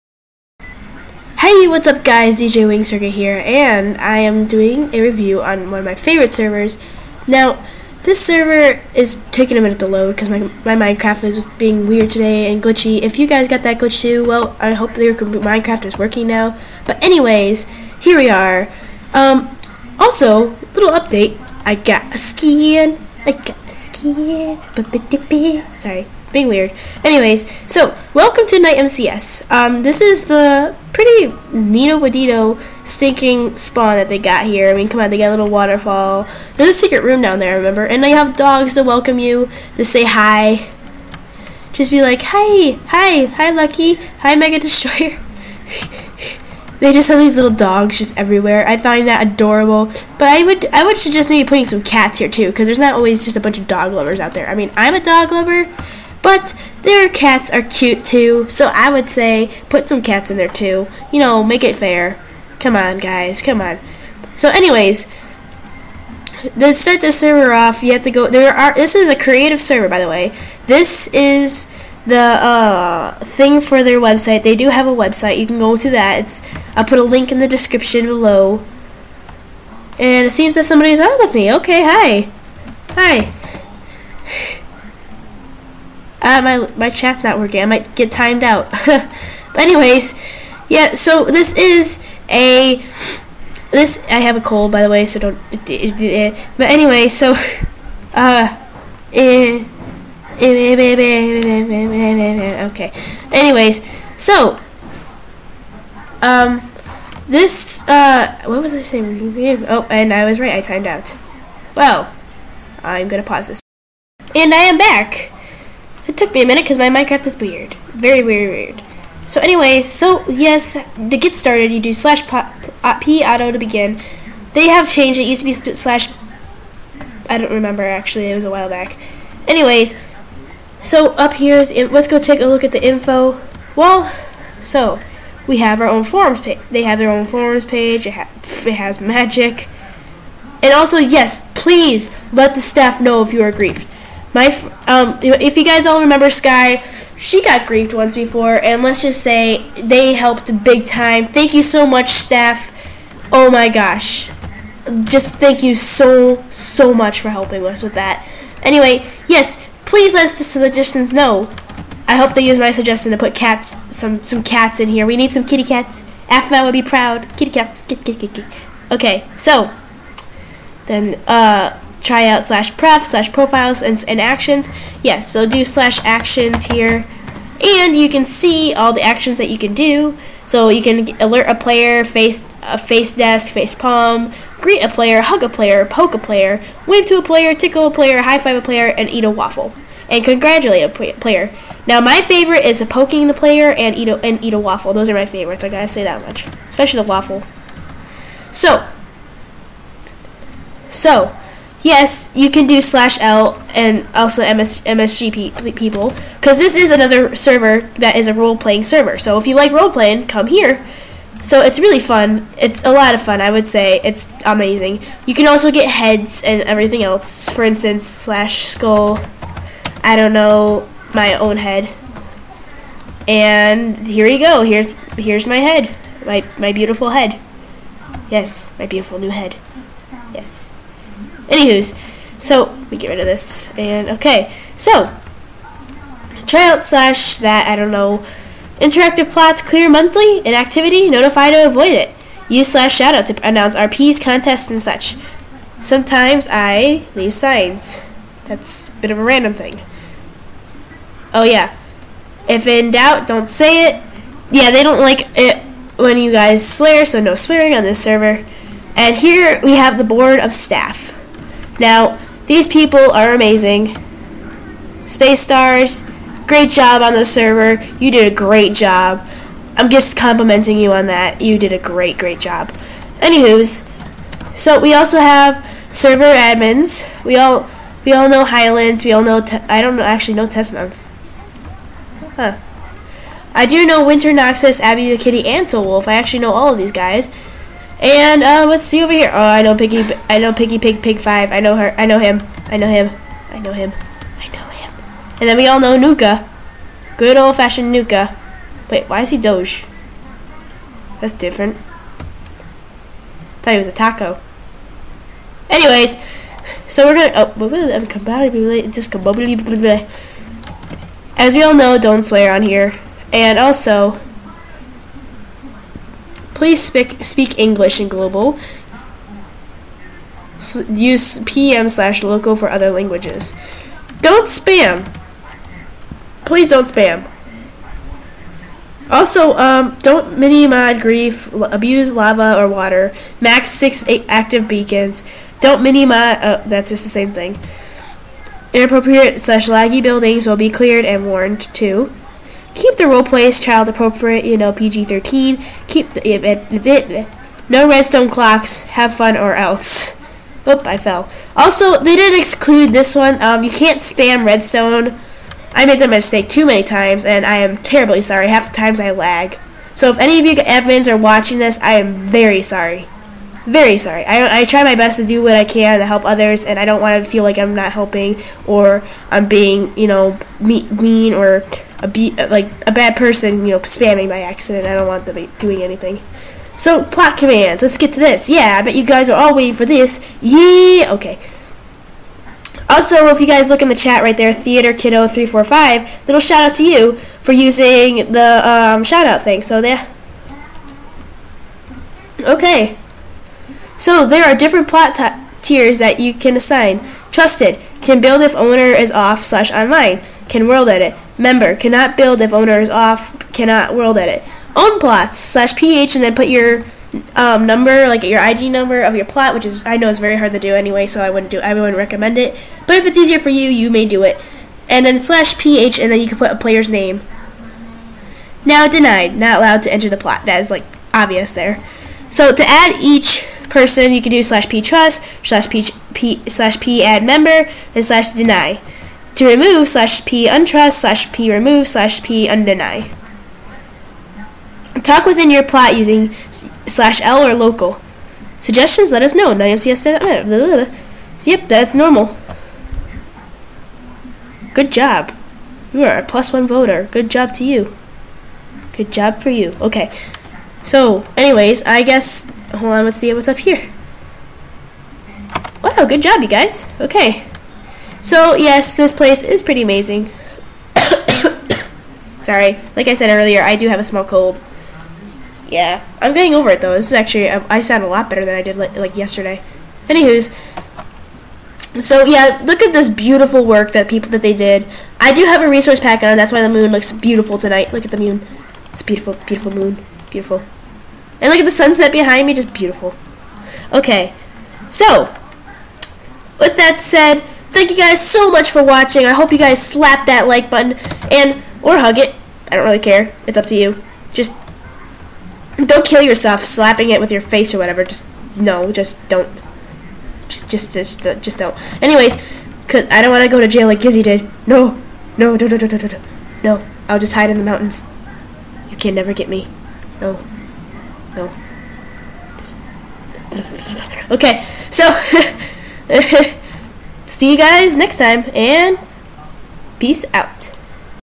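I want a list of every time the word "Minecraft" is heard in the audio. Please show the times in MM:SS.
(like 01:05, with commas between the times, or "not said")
00:10, 00:15, 01:56.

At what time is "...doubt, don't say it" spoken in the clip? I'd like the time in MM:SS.
04:12.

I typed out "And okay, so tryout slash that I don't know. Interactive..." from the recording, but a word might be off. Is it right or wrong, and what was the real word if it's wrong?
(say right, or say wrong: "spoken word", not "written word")
right.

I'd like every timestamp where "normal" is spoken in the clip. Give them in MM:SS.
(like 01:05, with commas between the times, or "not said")
07:21.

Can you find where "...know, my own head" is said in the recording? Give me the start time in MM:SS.
03:40.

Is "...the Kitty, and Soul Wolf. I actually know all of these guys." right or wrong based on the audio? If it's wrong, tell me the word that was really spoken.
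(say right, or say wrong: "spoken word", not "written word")
right.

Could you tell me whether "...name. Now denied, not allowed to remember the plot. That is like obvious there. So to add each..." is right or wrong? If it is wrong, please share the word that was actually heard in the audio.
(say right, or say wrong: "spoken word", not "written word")
wrong: "enter", not "remember".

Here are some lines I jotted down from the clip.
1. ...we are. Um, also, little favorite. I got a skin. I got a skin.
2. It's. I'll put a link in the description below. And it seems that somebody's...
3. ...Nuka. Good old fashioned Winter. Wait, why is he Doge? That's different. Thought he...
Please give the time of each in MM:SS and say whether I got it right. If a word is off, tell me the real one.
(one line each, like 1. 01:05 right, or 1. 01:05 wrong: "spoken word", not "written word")
1. 00:18 wrong: "update", not "favorite"
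2. 01:16 right
3. 04:55 wrong: "Nuka", not "Winter".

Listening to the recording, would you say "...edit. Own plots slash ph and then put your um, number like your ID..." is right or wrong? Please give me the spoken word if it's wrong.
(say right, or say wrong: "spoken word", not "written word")
right.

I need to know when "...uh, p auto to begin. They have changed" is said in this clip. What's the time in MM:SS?
02:02.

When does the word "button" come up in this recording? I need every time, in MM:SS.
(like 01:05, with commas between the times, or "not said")
08:10.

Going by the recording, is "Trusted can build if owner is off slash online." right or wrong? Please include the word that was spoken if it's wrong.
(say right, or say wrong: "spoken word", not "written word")
right.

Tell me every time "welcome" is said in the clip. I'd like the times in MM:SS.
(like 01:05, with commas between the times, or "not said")
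00:28, 00:38.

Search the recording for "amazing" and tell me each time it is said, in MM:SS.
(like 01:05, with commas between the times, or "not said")
03:34, 04:23, 07:39.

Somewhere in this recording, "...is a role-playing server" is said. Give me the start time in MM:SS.
03:28.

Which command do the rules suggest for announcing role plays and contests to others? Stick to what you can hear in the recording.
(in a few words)
/shoutout.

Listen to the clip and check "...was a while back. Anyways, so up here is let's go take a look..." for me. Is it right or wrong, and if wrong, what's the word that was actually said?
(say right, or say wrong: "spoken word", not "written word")
right.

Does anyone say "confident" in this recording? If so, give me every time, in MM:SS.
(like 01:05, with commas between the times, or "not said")
not said.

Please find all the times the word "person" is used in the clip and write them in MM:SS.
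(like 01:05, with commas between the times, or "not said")
06:13, 07:03.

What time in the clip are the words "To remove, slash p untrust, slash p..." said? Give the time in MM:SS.
07:09.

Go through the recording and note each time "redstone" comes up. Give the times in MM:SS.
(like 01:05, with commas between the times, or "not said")
05:47, 05:54.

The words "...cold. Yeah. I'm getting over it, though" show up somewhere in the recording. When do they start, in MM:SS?
07:44.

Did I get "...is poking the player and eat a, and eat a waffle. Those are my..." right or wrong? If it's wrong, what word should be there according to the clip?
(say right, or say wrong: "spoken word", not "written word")
right.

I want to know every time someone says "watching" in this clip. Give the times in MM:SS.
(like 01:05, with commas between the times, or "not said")
06:01, 08:08.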